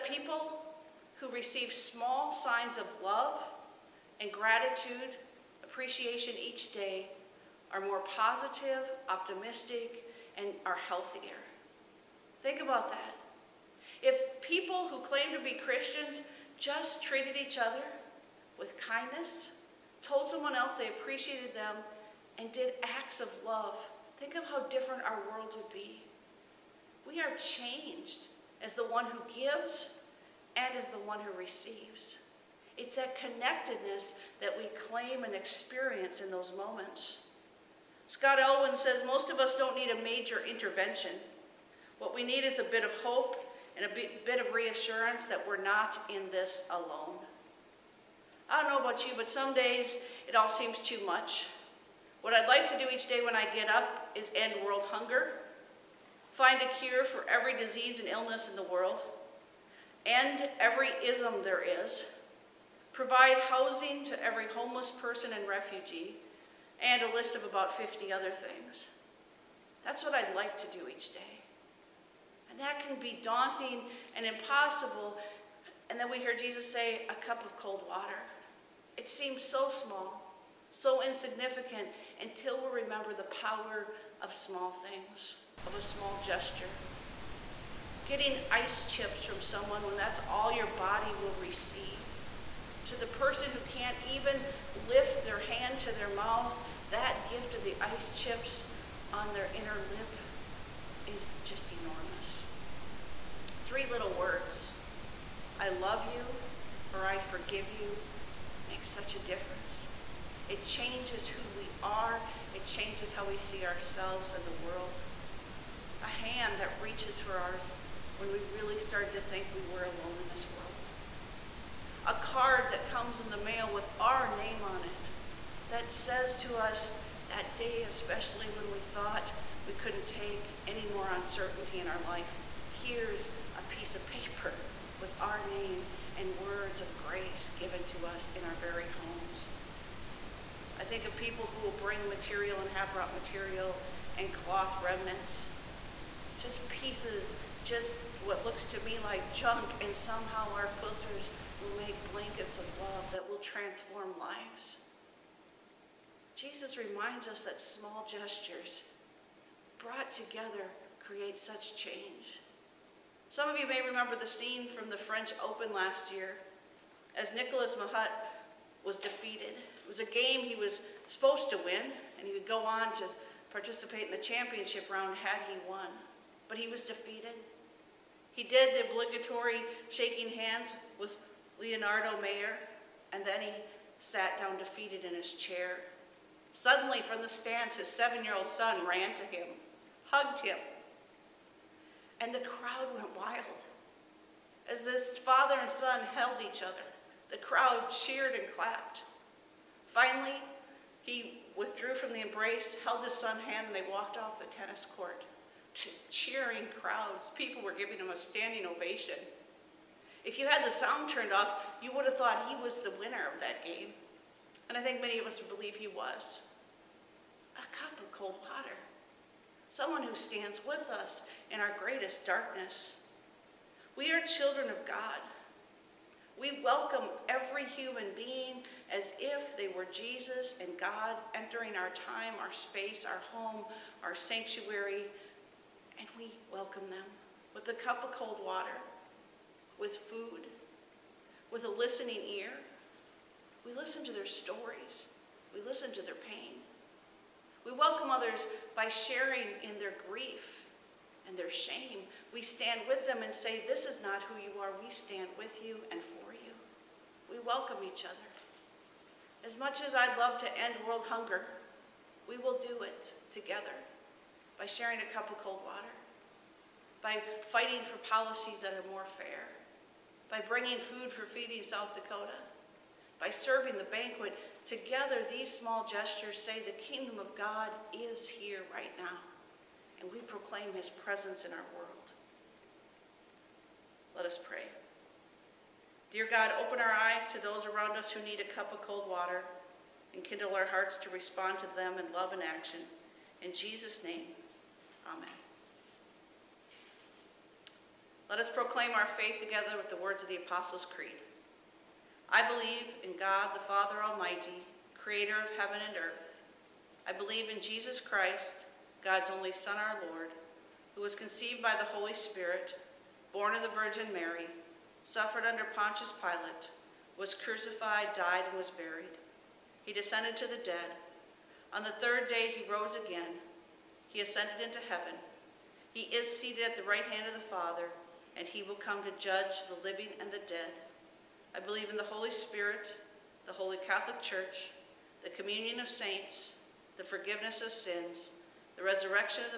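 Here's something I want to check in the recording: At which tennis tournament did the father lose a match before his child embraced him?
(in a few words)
French Open.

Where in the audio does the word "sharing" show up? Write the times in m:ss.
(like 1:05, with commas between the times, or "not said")
4:08, 4:24.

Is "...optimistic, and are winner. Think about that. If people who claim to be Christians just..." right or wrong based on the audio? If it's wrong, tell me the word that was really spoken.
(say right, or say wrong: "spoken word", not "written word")
wrong: "healthier", not "winner".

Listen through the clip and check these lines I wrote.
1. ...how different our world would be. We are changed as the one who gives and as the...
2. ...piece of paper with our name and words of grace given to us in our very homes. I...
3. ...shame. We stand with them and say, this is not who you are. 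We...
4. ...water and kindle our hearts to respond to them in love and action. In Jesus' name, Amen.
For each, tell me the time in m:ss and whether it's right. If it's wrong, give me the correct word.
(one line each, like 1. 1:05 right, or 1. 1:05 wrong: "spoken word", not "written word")
1. 0:24 right
2. 2:13 right
3. 4:11 right
4. 4:49 right.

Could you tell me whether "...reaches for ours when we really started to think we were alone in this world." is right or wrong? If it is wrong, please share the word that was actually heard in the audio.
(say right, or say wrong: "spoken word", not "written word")
right.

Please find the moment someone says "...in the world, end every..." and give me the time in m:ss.
0:58.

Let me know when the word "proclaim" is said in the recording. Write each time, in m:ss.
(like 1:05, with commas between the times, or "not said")
4:40, 4:58.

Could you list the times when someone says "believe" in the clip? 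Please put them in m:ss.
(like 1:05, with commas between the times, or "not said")
3:35, 5:02, 5:07, 5:31.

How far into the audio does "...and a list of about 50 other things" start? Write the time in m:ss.
1:06.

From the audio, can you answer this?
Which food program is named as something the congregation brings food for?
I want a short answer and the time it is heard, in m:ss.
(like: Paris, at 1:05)
Feeding South Dakota, at 4:31.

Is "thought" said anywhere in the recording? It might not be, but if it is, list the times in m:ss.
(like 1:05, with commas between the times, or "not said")
2:08, 3:32.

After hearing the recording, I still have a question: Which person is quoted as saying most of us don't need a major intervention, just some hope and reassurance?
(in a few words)
Scott Elwin.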